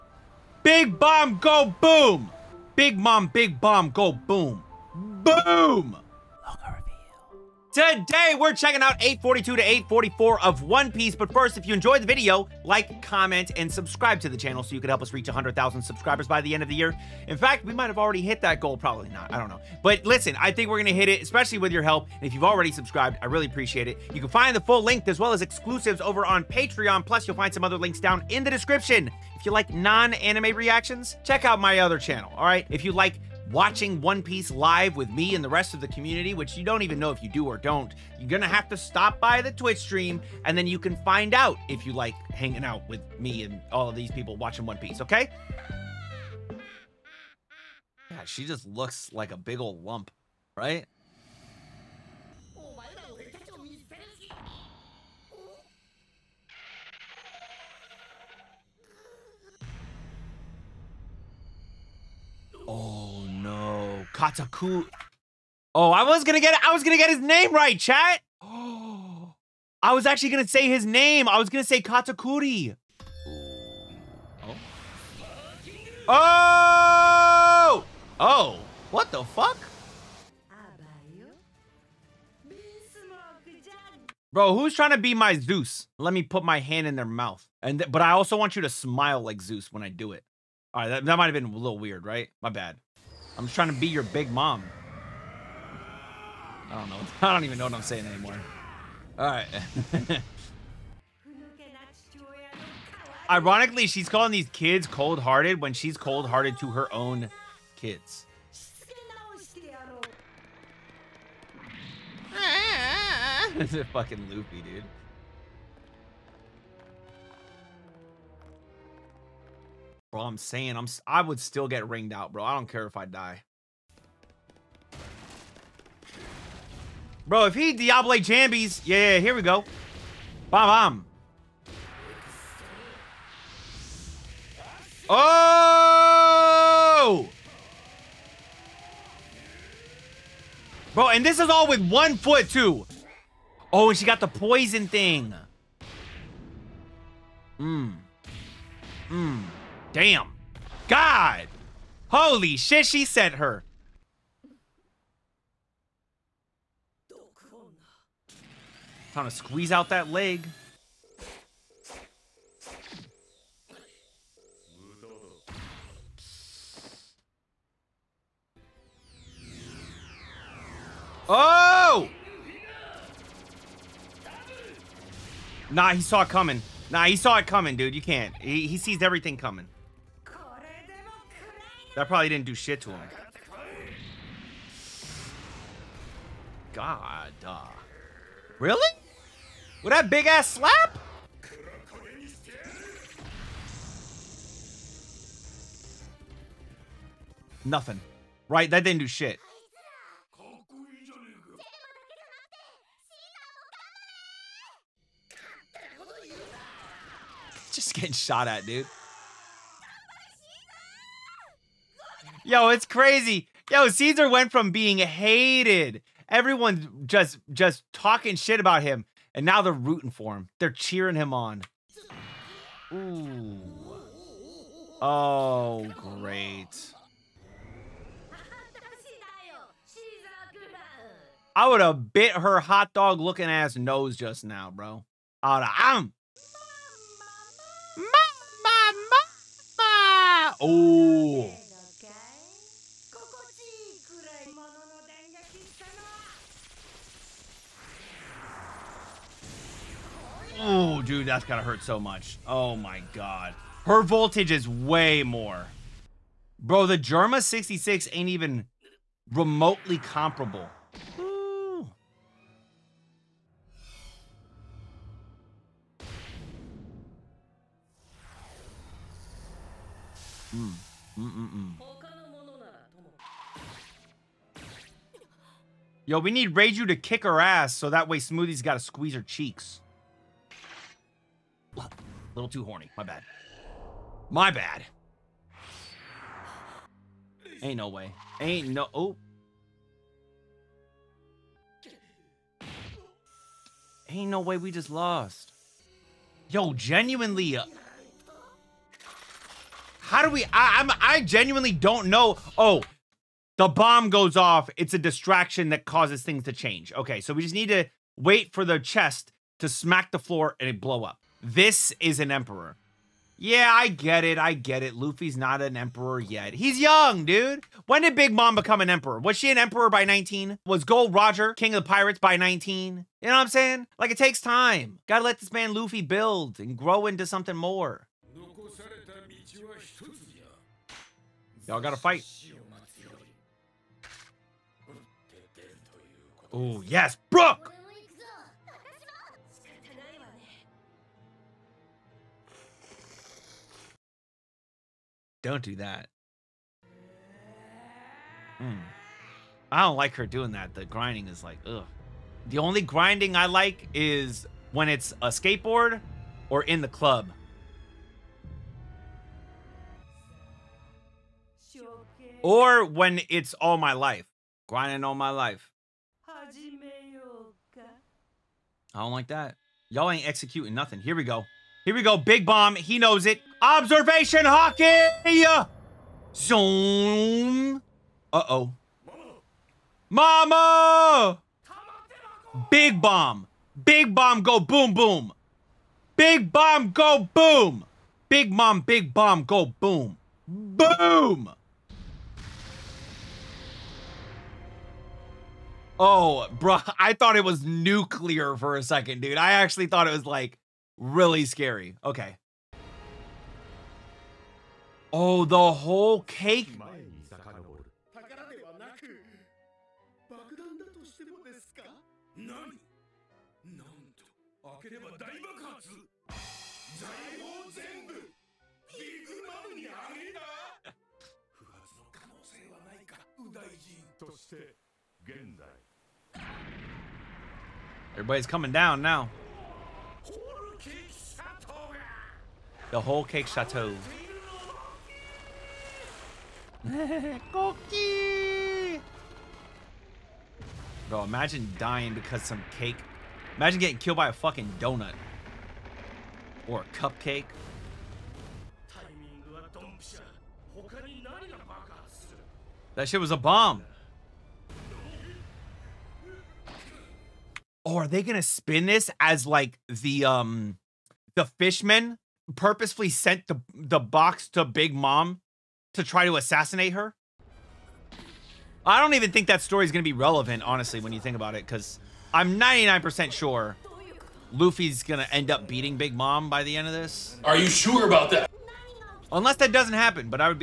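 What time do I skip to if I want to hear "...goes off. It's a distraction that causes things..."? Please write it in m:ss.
5:04.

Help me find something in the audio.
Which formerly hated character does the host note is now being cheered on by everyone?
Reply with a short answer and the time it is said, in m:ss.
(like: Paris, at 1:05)
Caesar, at 3:33.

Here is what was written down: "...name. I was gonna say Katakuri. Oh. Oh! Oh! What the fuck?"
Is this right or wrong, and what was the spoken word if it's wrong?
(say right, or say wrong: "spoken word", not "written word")
right.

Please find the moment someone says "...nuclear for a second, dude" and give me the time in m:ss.
6:37.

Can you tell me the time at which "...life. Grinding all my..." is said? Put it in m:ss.
6:03.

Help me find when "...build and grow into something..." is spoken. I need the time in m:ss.
5:26.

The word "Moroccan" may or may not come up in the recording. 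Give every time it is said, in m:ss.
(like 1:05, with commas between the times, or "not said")
not said.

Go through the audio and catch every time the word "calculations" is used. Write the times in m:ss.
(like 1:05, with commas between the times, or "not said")
not said.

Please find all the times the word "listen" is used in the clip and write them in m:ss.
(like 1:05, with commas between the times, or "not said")
0:20.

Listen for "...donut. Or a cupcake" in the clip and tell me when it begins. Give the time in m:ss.
7:24.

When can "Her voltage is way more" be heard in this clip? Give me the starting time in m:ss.
4:13.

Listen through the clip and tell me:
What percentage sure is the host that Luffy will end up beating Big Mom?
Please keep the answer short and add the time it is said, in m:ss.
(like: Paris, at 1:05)
99%, at 7:52.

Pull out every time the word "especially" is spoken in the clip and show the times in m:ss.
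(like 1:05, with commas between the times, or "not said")
0:21.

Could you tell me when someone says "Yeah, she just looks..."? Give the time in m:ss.
0:48.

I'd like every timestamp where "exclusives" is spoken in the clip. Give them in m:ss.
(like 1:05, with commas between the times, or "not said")
0:25.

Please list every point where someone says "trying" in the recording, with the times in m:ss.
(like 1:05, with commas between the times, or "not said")
1:24, 1:33.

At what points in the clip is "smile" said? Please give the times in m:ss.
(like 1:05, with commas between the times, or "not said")
1:28.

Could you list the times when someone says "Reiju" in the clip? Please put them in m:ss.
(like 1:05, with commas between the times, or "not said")
4:36.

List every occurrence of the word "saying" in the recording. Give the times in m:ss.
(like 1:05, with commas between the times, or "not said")
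1:37, 2:00, 5:23.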